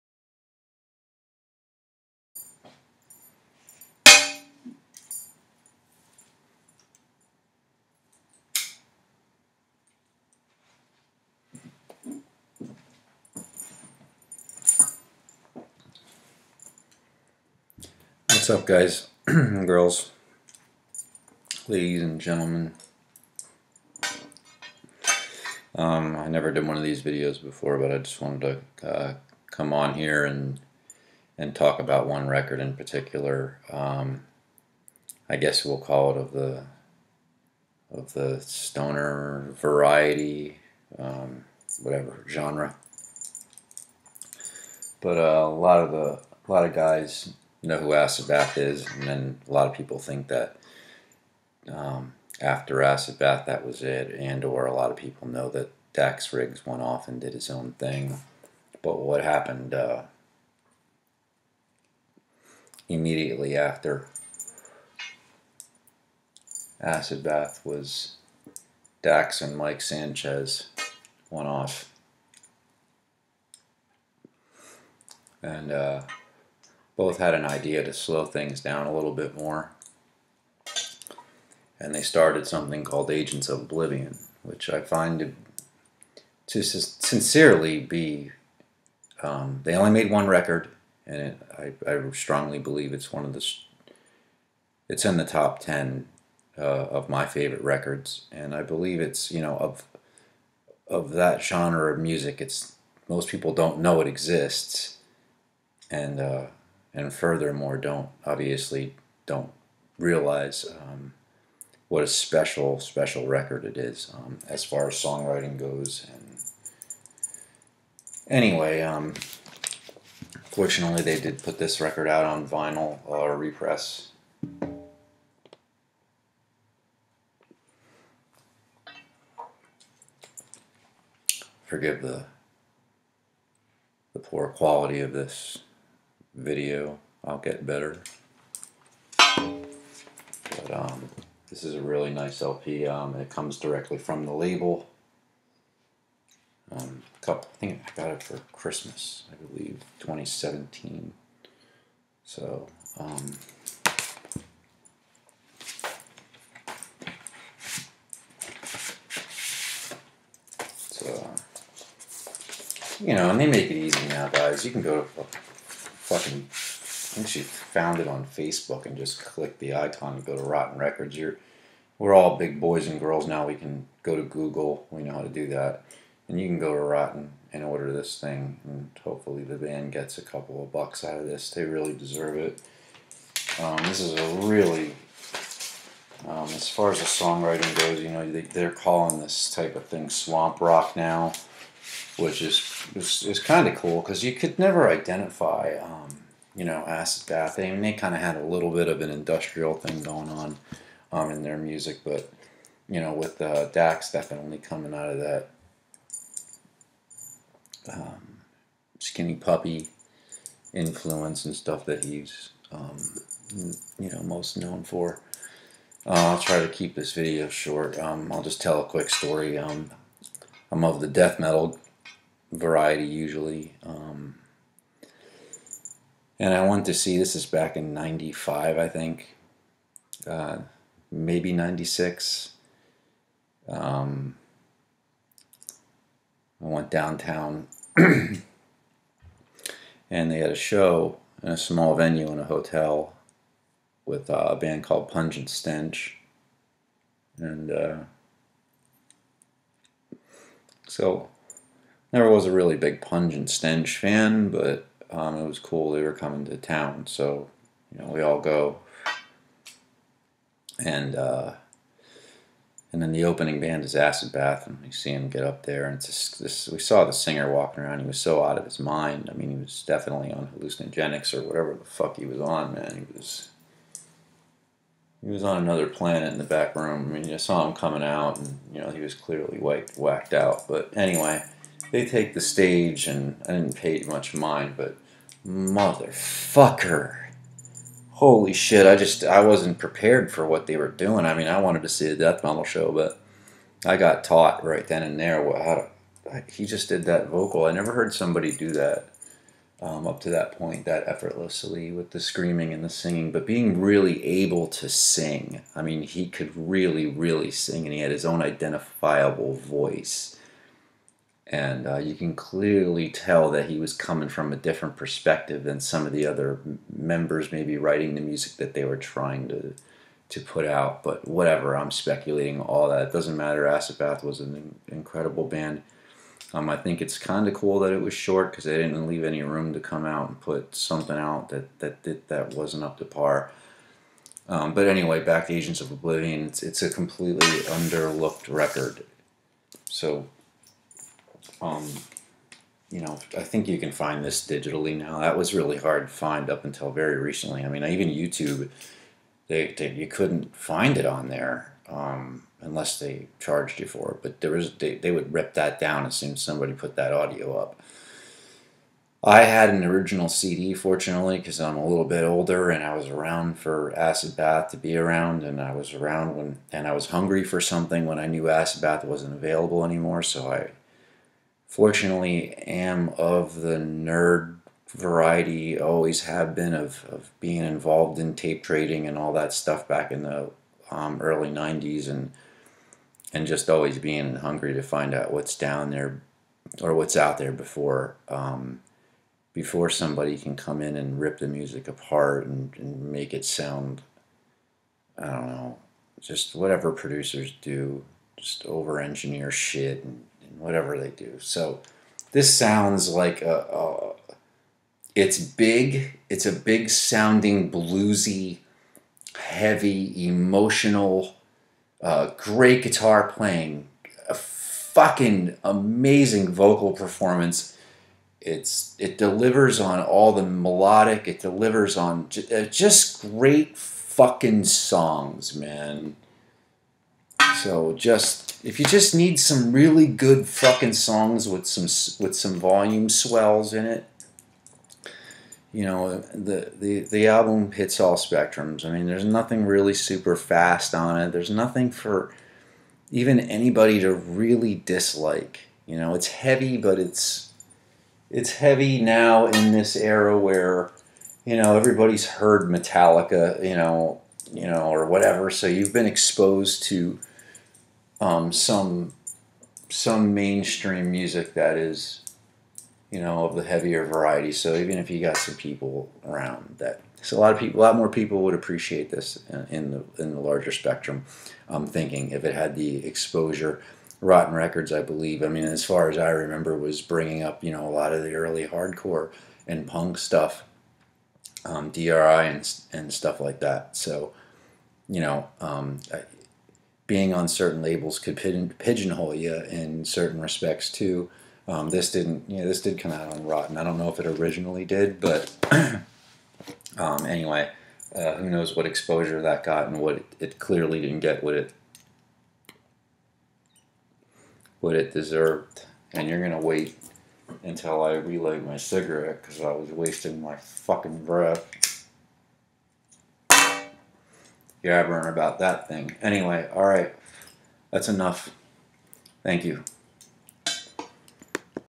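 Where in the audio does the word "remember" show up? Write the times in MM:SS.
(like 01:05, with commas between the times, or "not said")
07:56.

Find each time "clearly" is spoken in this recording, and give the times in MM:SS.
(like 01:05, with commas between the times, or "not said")
04:39, 05:12, 08:20.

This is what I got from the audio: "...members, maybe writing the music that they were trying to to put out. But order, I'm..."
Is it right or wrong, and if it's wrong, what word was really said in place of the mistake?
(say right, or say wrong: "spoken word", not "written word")
wrong: "whatever", not "order".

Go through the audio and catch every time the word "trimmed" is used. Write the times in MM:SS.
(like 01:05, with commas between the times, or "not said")
not said.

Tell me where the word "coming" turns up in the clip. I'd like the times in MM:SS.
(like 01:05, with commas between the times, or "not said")
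03:24, 04:16, 04:37, 05:13.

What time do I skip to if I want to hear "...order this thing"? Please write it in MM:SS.
02:57.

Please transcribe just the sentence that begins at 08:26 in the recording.
And you're gonna wait until I relight my cigarette because I was wasting my fucking breath yabbering about that thing.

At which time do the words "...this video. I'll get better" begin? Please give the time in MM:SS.
02:15.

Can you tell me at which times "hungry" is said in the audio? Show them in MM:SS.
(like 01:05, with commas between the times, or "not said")
06:07, 06:24.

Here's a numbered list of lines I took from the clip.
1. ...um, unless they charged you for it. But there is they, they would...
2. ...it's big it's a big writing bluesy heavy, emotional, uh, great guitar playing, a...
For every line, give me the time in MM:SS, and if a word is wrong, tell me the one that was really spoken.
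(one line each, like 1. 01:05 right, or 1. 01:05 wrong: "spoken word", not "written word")
1. 05:51 right
2. 06:45 wrong: "sounding", not "writing".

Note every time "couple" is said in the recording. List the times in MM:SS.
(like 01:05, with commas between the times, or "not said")
02:27, 03:00.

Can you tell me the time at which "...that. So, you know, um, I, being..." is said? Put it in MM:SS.
08:03.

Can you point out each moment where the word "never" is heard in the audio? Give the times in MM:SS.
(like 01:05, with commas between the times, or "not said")
00:26, 03:14, 04:12, 04:57.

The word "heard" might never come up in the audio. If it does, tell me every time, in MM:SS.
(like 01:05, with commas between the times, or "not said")
04:57, 07:32.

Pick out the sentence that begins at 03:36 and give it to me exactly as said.
Uh, I'll try to keep this video short.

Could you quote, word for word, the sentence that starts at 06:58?
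It's it delivers on all the melodic.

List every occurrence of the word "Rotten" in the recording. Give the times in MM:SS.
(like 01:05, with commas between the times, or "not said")
02:50, 02:56, 07:54, 08:13.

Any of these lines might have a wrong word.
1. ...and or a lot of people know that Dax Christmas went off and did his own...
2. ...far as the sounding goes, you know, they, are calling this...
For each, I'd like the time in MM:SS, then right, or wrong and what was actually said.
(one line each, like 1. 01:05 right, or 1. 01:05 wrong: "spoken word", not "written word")
1. 00:54 wrong: "Riggs", not "Christmas"
2. 03:06 wrong: "songwriting", not "sounding".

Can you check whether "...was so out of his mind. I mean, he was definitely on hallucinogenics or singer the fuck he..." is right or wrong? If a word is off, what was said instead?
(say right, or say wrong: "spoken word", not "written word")
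wrong: "whatever", not "singer".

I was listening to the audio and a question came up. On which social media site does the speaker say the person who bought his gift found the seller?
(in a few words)
Facebook.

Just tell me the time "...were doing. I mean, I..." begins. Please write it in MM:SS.
04:50.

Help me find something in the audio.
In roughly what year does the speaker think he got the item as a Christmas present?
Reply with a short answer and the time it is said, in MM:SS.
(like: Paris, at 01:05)
2017, at 02:29.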